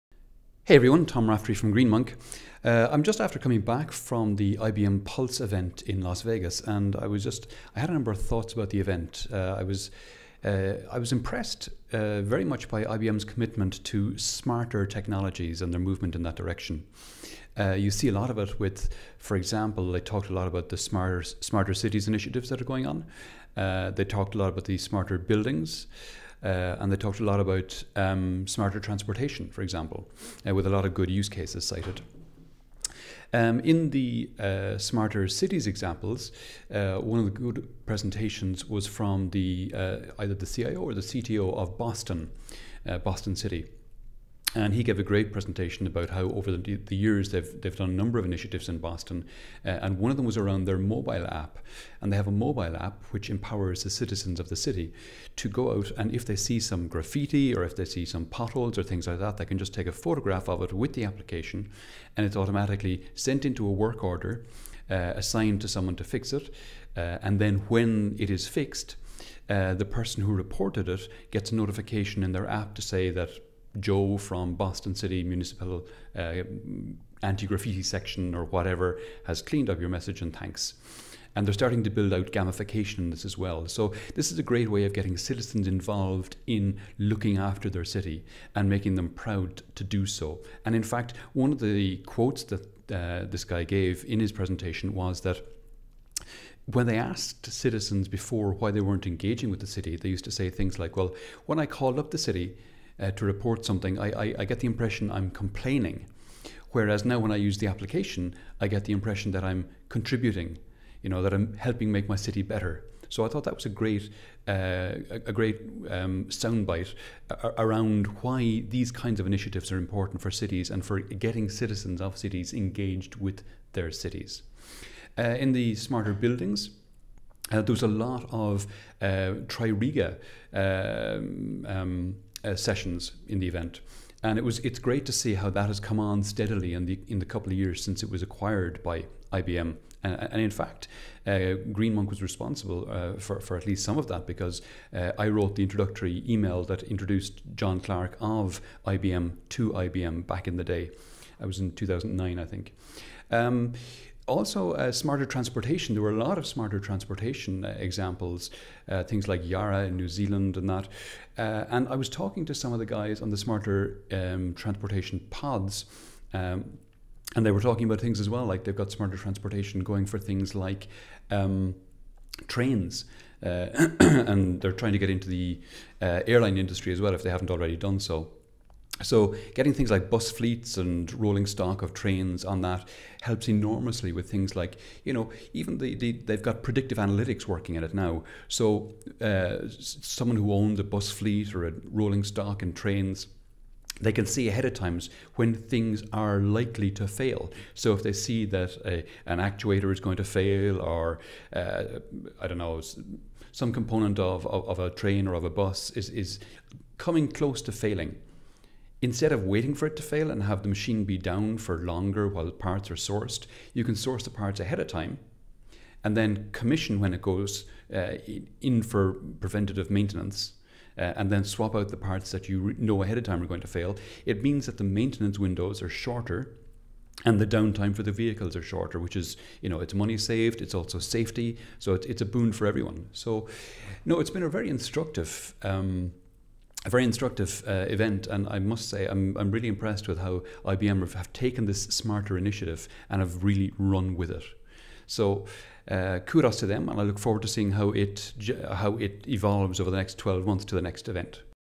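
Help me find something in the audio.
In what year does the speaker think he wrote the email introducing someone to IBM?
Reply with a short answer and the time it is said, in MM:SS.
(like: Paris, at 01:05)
2009, at 02:31.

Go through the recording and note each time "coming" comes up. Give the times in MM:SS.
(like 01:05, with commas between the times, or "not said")
00:03, 03:26.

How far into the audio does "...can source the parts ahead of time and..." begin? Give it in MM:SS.
03:33.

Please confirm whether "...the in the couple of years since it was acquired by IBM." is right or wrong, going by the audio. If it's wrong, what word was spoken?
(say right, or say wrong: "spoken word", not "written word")
right.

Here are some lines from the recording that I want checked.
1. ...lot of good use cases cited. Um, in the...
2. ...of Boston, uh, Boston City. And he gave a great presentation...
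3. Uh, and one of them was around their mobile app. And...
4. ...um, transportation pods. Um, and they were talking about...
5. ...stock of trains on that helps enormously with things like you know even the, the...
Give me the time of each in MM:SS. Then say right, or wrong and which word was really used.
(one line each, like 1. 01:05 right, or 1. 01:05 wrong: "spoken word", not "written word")
1. 00:30 right
2. 00:41 right
3. 00:49 right
4. 02:44 right
5. 03:01 right.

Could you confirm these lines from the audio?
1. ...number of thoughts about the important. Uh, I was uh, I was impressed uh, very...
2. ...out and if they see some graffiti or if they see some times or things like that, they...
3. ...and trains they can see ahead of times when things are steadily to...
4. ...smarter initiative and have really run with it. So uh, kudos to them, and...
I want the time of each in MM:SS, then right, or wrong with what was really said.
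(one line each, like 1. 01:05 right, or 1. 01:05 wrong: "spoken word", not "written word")
1. 00:07 wrong: "event", not "important"
2. 00:55 wrong: "potholes", not "times"
3. 03:12 wrong: "likely", not "steadily"
4. 04:01 right.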